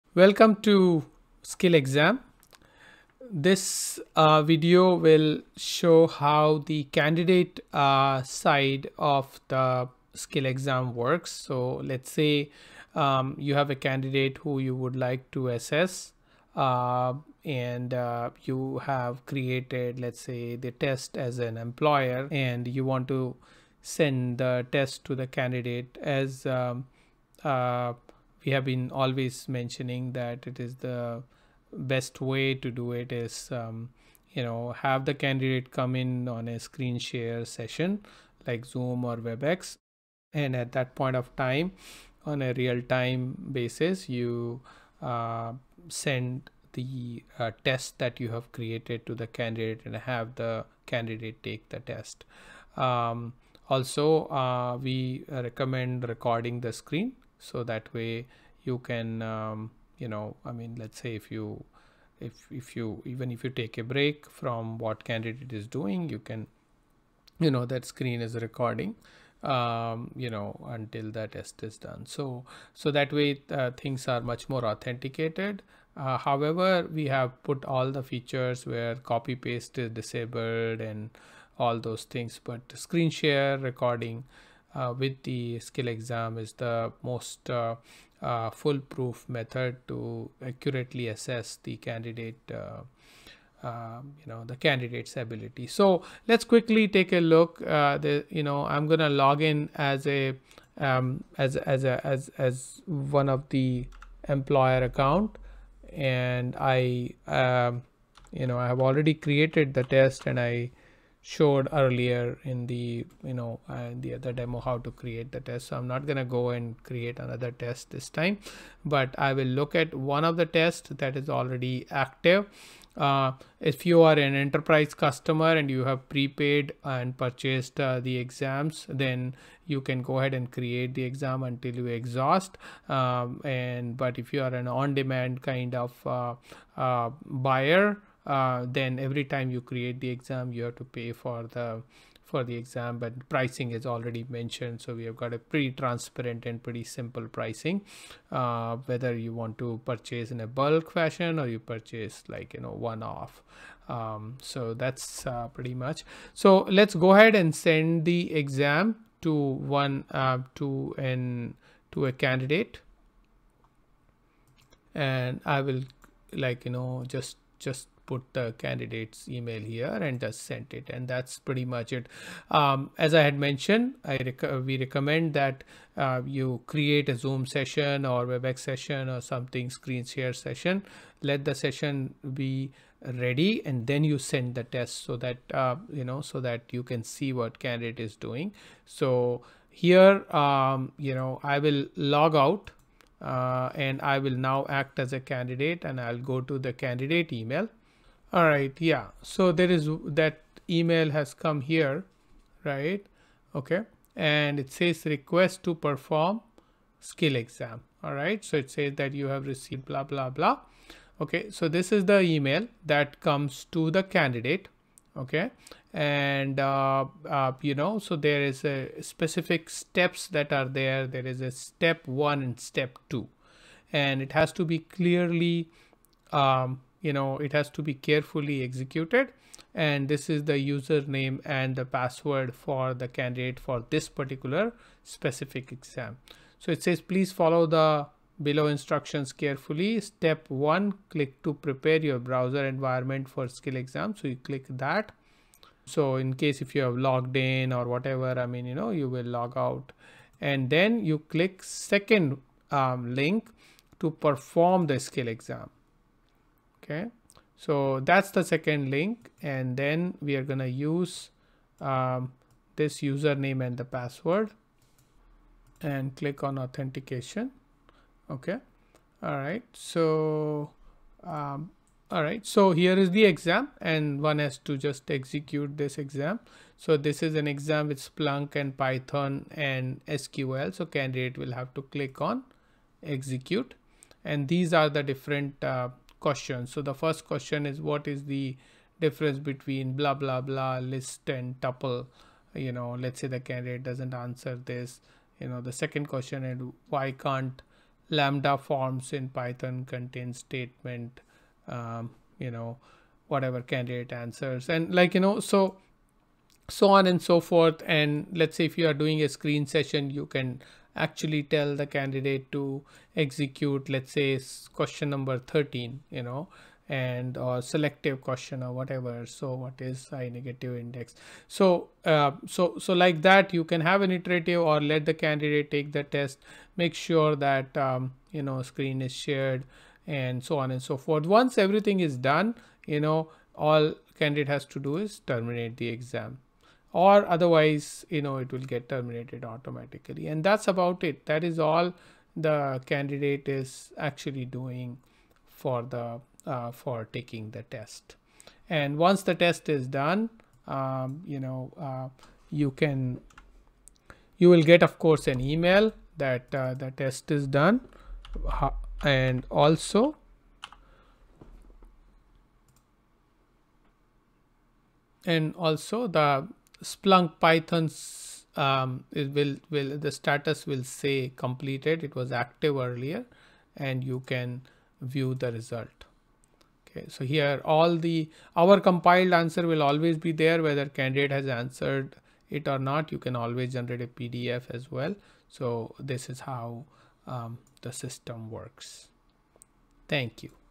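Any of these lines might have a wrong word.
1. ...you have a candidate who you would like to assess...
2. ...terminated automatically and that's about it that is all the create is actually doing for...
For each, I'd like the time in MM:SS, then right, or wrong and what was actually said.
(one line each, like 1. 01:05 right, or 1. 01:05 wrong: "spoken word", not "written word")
1. 00:13 right
2. 05:38 wrong: "candidate", not "create".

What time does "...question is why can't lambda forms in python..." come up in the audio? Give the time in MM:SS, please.
04:56.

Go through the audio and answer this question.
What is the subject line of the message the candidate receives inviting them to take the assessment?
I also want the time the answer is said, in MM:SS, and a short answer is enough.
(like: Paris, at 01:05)
Request to perform skill exam, at 03:25.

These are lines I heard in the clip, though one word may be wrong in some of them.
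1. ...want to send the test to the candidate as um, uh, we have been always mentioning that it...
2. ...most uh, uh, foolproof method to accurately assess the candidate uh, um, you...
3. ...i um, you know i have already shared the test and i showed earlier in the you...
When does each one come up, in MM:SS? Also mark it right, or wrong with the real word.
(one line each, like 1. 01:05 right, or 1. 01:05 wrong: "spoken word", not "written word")
1. 00:22 right
2. 01:27 right
3. 01:46 wrong: "created", not "shared".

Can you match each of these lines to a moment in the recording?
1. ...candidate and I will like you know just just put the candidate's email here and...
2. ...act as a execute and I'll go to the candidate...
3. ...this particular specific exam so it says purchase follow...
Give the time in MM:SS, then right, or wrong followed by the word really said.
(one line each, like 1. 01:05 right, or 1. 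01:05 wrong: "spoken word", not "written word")
1. 02:42 right
2. 03:14 wrong: "candidate", not "execute"
3. 03:53 wrong: "please", not "purchase".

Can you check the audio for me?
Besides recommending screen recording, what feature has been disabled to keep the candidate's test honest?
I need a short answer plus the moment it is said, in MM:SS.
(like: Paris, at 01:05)
copy paste, at 01:19.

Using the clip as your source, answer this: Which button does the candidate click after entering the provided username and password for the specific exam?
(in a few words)
authentication.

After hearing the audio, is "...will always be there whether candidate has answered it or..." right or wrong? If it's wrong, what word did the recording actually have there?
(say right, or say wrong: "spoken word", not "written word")
right.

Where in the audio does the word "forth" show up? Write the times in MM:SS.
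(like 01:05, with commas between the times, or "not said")
05:07, 05:30.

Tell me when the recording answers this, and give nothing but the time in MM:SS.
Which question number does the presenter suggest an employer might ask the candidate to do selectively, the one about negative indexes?
05:15.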